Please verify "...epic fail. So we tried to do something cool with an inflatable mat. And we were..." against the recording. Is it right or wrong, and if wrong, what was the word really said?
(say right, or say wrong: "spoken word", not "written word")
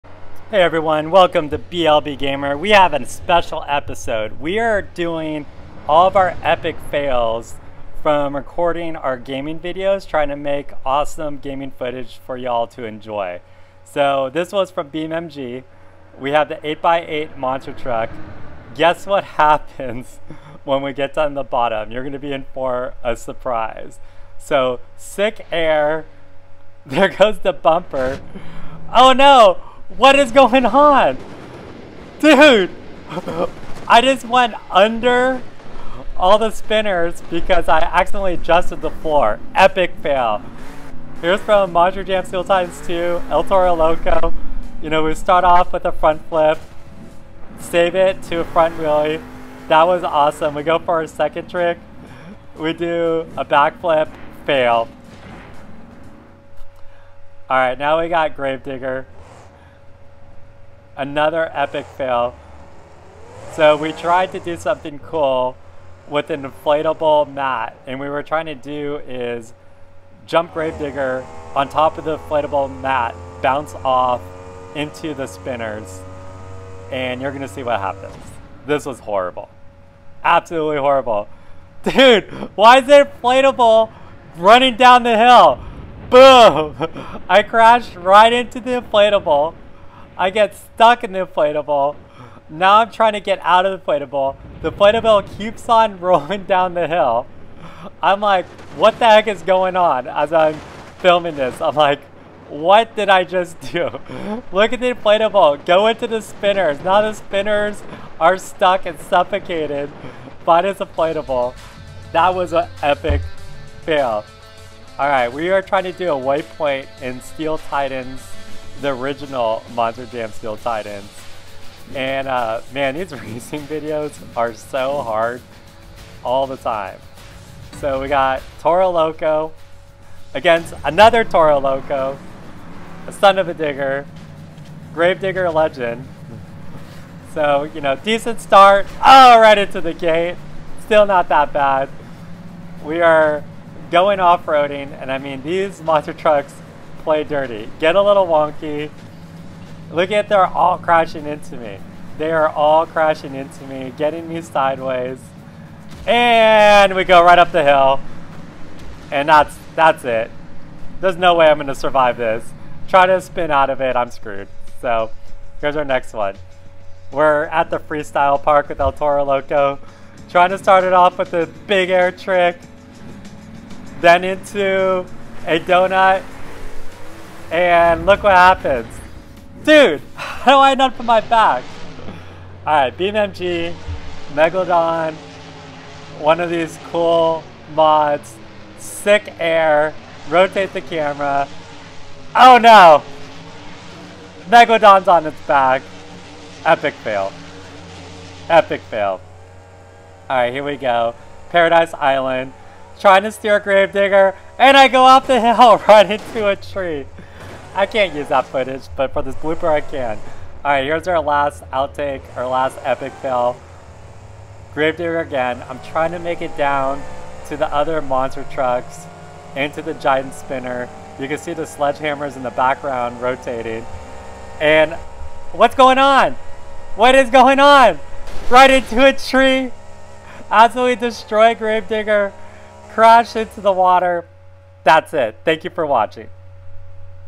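right.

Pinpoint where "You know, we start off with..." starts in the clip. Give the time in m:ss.
0:44.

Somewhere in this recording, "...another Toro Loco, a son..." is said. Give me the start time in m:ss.
2:10.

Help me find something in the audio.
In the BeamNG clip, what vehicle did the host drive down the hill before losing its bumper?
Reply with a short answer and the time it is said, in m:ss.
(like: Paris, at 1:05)
8x8 monster truck, at 0:16.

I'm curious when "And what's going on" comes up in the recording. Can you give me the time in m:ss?
3:44.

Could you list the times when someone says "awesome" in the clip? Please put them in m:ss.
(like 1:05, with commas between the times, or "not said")
0:10, 0:50.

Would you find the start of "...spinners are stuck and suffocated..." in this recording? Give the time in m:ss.
1:47.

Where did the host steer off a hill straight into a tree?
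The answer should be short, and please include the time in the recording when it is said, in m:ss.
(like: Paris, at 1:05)
Paradise Island, at 3:21.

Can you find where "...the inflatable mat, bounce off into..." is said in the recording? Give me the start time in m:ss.
1:12.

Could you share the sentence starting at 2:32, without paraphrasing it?
They are all crashing into me, getting me sideways.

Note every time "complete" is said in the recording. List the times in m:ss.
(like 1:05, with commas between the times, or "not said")
not said.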